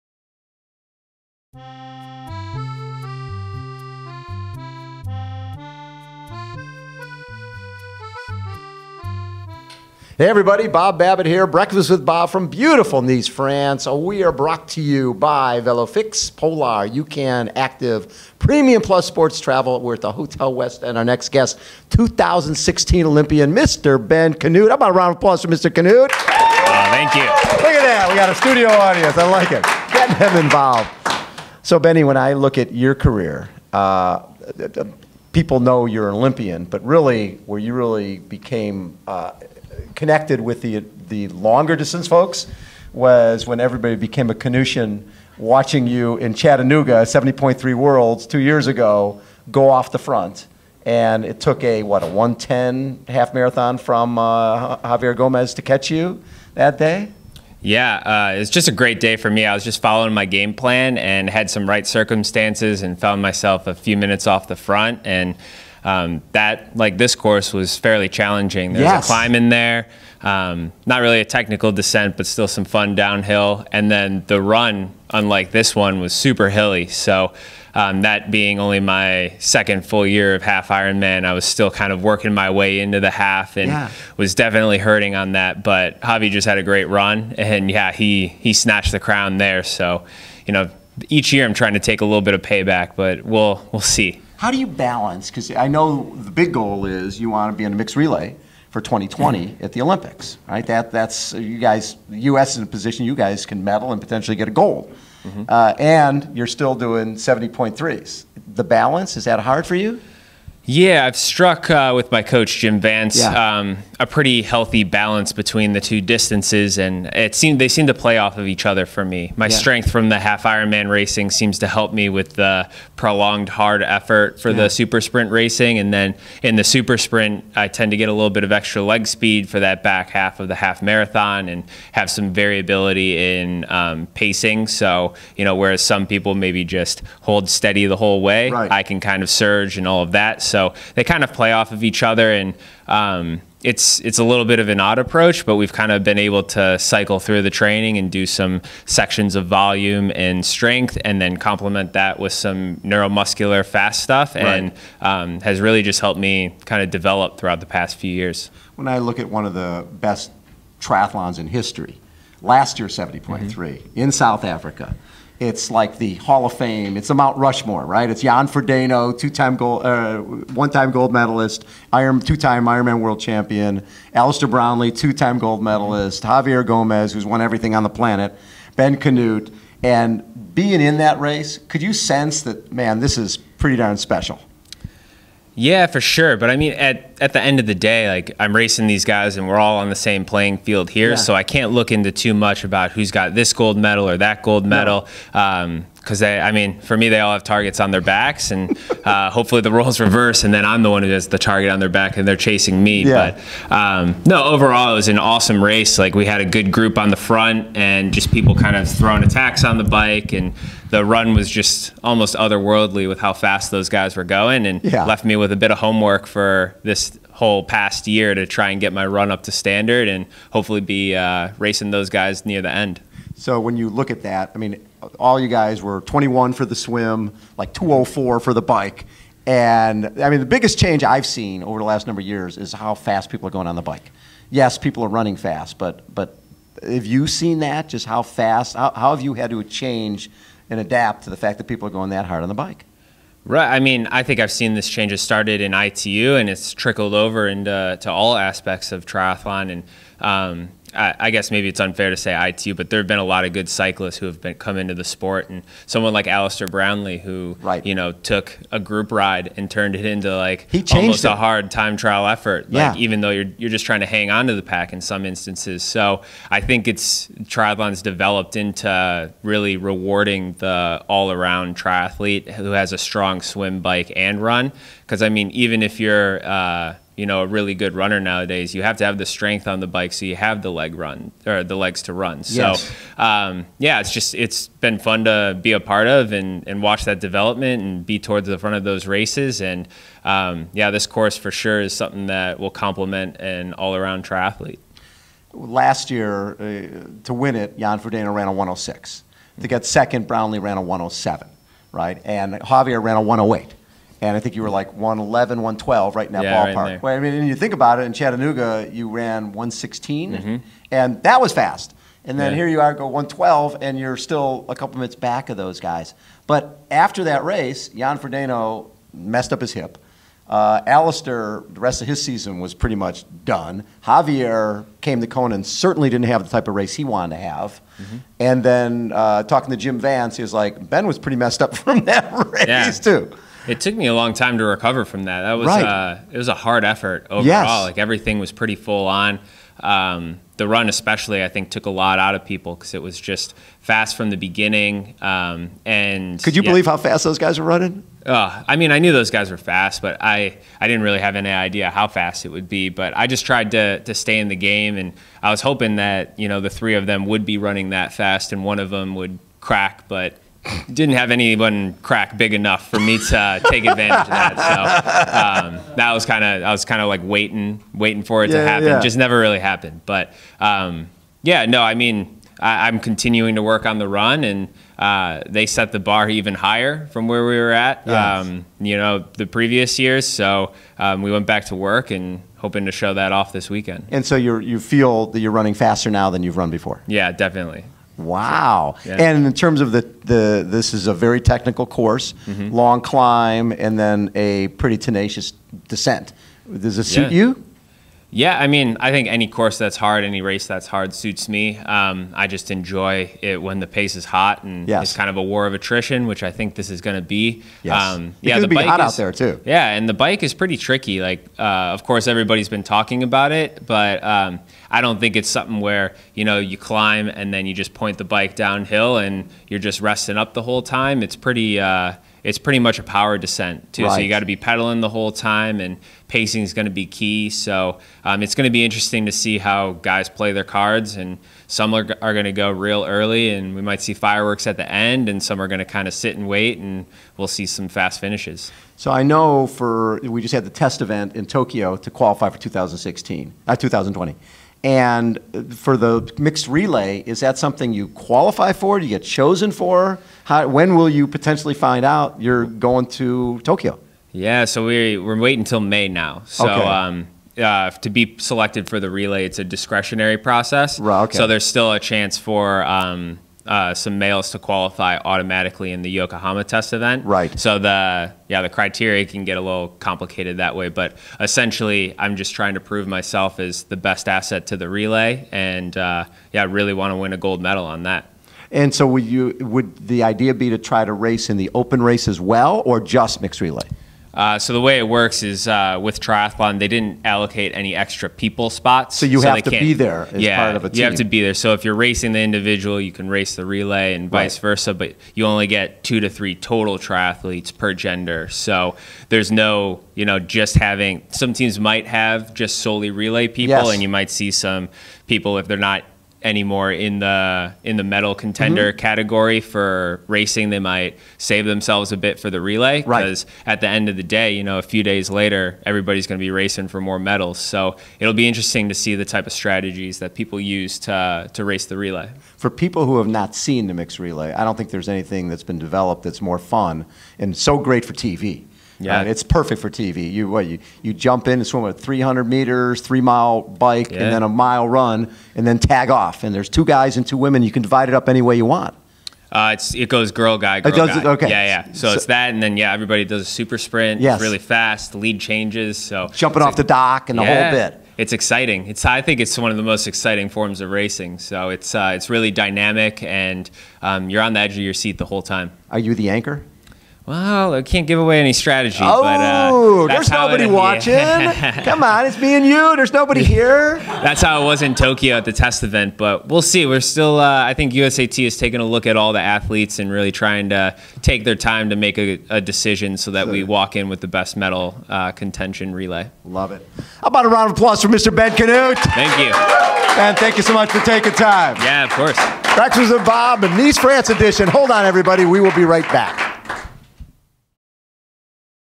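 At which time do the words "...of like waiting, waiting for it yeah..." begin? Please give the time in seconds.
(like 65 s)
367 s.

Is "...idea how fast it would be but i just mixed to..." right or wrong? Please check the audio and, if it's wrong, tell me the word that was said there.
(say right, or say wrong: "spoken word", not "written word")
wrong: "tried", not "mixed".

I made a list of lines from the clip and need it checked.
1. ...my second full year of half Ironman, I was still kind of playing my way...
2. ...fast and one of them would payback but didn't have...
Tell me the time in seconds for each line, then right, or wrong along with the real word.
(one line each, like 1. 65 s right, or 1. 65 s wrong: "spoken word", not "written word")
1. 78 s wrong: "working", not "playing"
2. 358 s wrong: "crack", not "payback".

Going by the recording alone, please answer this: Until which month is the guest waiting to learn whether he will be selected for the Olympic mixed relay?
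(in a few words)
May.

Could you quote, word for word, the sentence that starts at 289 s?
And um, yeah, this course for sure is something that will complement an all-around triathlete.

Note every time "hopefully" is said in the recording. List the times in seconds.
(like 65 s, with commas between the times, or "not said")
199 s, 220 s.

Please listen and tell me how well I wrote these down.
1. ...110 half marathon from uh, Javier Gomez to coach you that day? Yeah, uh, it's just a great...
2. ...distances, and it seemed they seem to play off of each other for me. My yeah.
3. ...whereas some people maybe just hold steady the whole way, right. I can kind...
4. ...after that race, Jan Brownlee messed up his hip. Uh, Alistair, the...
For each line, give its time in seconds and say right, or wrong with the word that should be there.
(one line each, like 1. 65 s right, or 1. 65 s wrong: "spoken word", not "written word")
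1. 52 s wrong: "catch", not "coach"
2. 116 s right
3. 135 s right
4. 316 s wrong: "Frodeno", not "Brownlee".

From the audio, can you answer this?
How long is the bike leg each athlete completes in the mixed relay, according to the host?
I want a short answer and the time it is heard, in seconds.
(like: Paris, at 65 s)
3 miles, at 533 s.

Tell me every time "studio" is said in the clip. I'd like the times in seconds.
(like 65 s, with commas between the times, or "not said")
28 s.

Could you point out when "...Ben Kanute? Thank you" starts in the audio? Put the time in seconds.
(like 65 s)
578 s.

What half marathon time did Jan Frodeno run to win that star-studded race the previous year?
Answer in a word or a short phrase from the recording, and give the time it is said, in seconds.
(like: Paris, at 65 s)
1:06, at 298 s.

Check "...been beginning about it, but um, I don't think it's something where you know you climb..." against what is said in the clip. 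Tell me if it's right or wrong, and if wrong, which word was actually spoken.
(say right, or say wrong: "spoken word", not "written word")
wrong: "talking", not "beginning".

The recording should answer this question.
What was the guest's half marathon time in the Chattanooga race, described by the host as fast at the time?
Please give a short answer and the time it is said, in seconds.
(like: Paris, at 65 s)
1:16, at 309 s.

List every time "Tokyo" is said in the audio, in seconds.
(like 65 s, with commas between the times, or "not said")
441 s, 453 s, 564 s.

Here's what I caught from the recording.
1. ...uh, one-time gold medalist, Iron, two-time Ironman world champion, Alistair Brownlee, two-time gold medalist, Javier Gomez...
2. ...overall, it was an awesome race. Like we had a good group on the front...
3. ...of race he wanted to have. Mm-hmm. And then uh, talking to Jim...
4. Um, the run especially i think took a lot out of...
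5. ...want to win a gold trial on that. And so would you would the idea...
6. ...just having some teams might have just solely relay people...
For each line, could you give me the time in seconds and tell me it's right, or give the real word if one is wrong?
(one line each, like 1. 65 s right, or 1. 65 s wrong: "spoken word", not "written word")
1. 169 s right
2. 204 s right
3. 326 s right
4. 339 s right
5. 476 s wrong: "medal", not "trial"
6. 500 s right.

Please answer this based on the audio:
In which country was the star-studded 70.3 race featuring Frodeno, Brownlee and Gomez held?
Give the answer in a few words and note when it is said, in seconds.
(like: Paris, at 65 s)
South Africa, at 164 s.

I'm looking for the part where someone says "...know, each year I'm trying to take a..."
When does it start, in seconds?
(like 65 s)
90 s.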